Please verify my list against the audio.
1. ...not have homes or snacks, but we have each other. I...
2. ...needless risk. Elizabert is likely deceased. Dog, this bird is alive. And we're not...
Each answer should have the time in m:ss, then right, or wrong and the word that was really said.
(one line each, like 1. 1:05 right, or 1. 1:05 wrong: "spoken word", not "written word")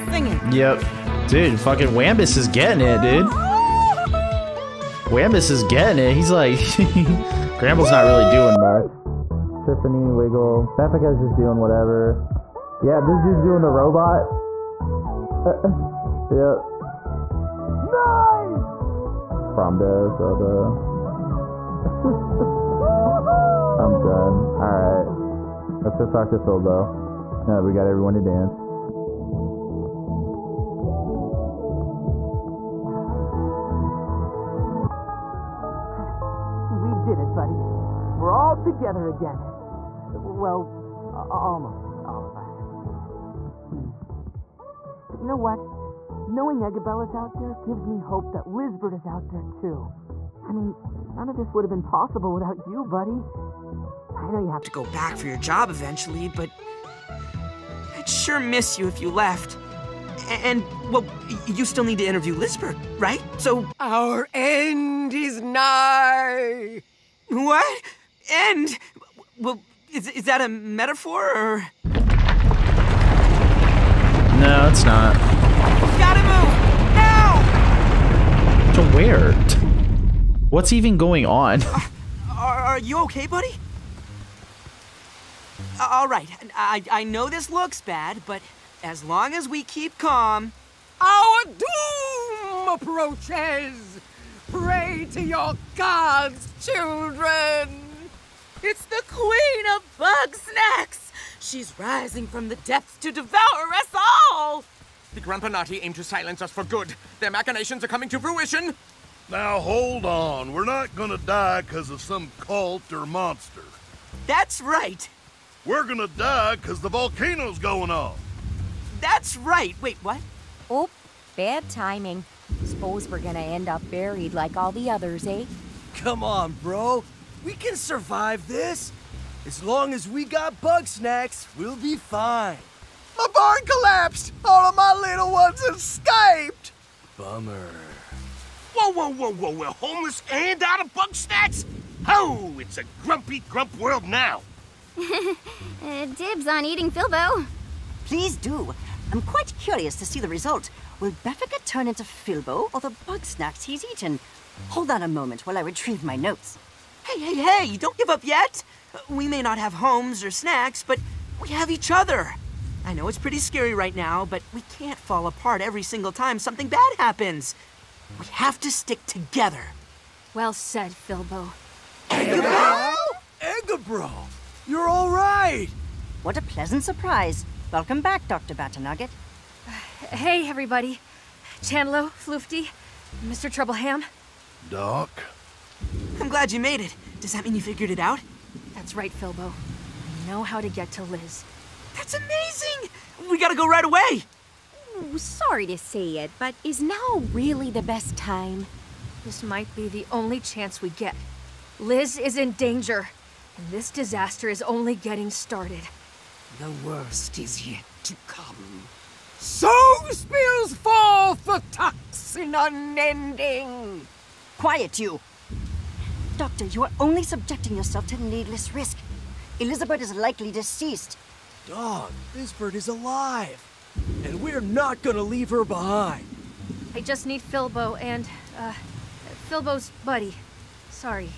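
1. 2:39 right
2. 3:38 right.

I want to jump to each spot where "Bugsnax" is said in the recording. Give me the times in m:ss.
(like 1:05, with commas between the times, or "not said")
1:39, 2:20, 2:33.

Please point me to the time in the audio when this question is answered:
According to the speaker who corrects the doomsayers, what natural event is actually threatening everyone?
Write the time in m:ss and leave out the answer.
1:56.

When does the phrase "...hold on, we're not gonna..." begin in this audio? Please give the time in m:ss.
1:49.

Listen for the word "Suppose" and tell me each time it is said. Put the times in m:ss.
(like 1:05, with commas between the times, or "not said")
2:02.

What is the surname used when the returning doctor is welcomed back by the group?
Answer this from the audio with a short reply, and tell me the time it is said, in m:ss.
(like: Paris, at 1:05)
Batternugget, at 2:58.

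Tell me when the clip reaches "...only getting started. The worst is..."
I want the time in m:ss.
3:24.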